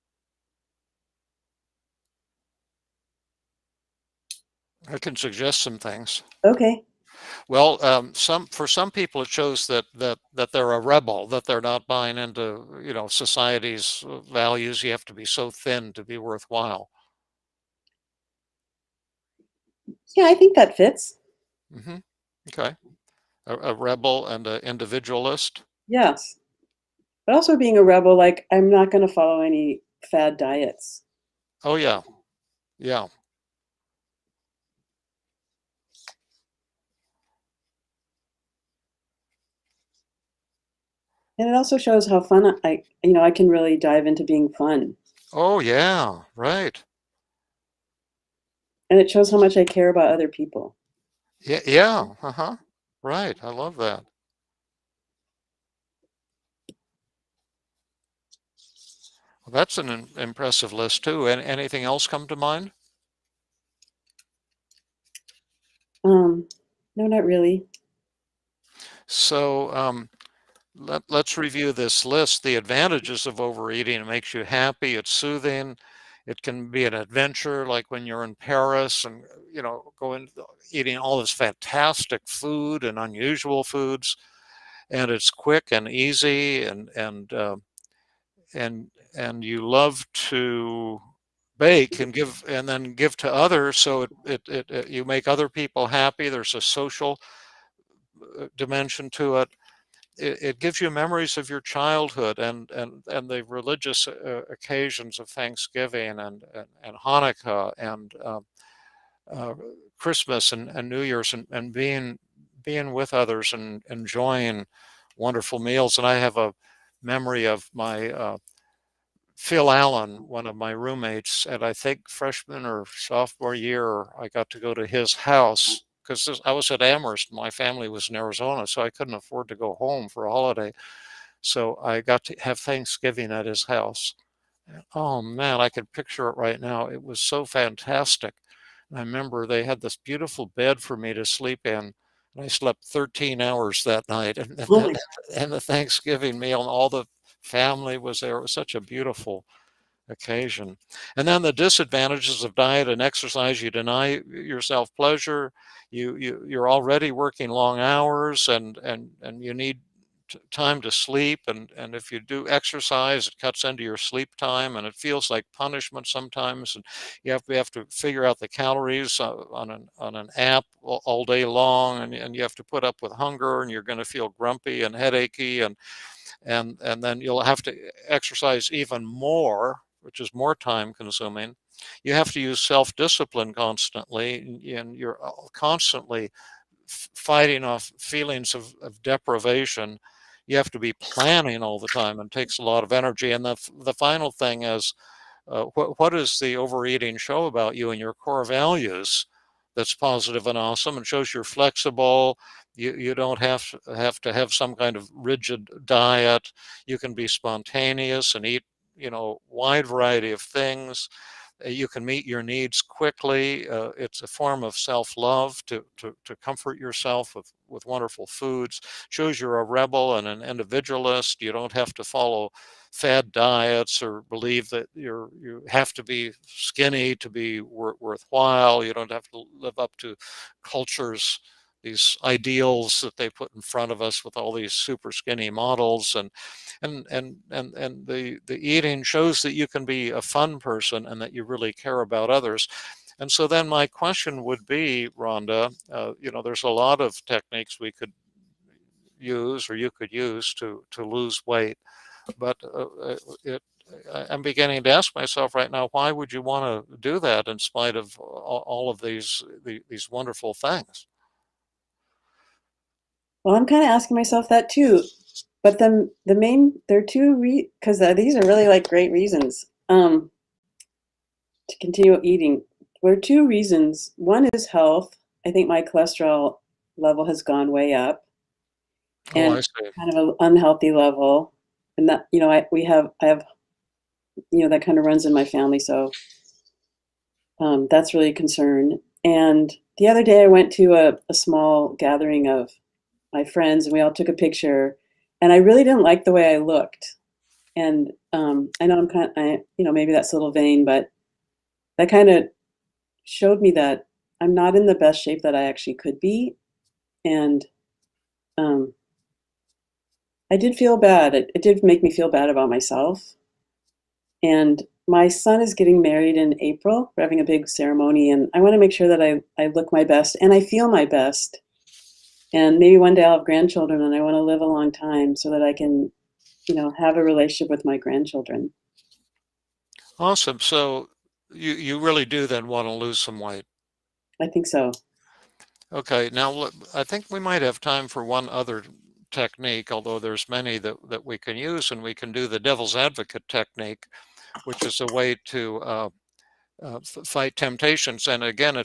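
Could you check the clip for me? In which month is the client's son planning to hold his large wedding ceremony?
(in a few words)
April.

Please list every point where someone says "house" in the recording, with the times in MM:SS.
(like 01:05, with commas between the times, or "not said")
02:05, 02:13.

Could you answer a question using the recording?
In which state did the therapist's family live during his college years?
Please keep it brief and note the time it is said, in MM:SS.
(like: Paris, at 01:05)
Arizona, at 02:08.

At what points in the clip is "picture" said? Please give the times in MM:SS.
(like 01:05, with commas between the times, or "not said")
02:15, 04:54.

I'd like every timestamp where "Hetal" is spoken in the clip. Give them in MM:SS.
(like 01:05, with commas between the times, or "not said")
not said.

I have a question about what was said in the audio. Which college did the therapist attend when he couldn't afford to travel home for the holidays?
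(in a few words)
Amherst.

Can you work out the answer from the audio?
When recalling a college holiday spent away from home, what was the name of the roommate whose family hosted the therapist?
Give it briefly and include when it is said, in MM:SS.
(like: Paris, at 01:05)
Phil Allen, at 01:59.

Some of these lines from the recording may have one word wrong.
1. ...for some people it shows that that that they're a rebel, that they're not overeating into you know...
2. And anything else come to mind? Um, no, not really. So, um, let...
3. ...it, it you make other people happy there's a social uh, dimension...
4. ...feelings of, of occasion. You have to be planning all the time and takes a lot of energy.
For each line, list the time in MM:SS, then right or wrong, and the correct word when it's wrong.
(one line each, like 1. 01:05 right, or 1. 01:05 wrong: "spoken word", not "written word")
1. 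00:08 wrong: "buying", not "overeating"
2. 01:01 right
3. 01:34 right
4. 03:07 wrong: "deprivation", not "occasion".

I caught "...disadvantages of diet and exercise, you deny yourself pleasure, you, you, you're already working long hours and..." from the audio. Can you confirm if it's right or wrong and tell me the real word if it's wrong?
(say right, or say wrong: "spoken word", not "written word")
right.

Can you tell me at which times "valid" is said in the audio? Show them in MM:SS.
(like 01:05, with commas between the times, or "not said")
not said.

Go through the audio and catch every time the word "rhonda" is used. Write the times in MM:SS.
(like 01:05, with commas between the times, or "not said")
04:05.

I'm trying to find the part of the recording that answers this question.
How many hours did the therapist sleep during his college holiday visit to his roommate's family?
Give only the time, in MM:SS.
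02:22.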